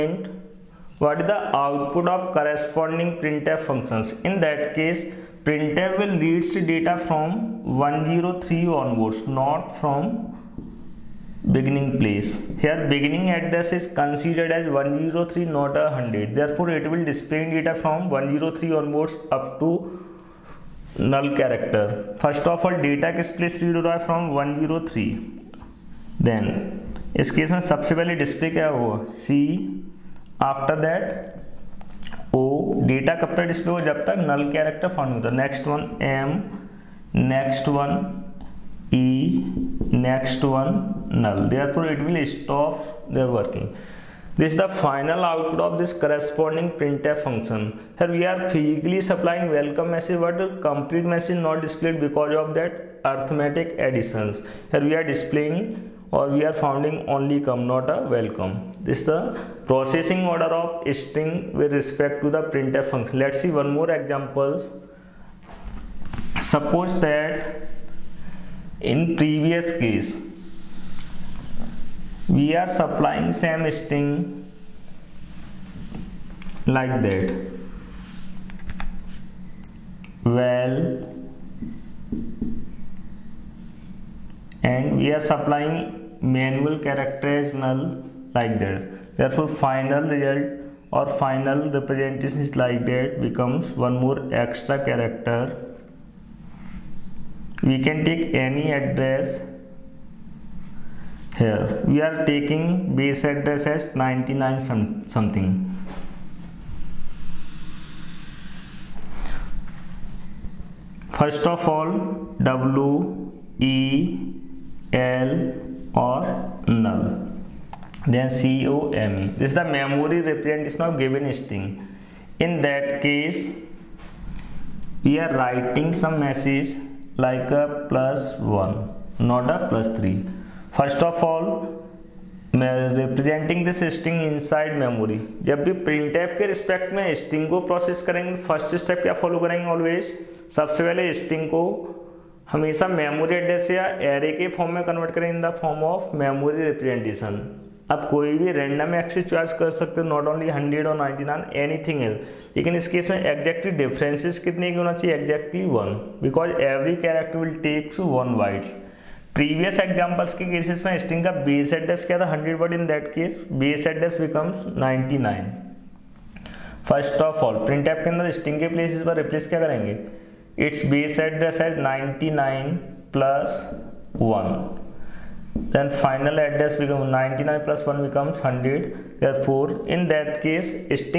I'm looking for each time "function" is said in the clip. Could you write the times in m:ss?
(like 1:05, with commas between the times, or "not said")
0:03, 0:47, 1:02.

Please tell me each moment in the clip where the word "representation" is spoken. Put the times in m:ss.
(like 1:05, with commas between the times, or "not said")
1:31, 2:00.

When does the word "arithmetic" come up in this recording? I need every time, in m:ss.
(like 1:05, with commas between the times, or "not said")
0:53.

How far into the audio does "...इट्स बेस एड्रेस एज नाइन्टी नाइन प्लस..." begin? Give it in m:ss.
2:50.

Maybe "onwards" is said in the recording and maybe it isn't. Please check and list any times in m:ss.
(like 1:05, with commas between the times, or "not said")
0:08, 0:18.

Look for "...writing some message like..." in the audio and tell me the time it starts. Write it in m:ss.
2:05.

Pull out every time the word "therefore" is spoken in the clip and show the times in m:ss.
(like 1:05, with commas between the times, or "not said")
0:16, 0:41, 1:29, 2:59.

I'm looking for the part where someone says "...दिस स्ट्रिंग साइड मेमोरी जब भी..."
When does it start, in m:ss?
2:13.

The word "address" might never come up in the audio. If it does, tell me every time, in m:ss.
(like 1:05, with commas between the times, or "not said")
0:13, 1:38, 1:43, 2:56.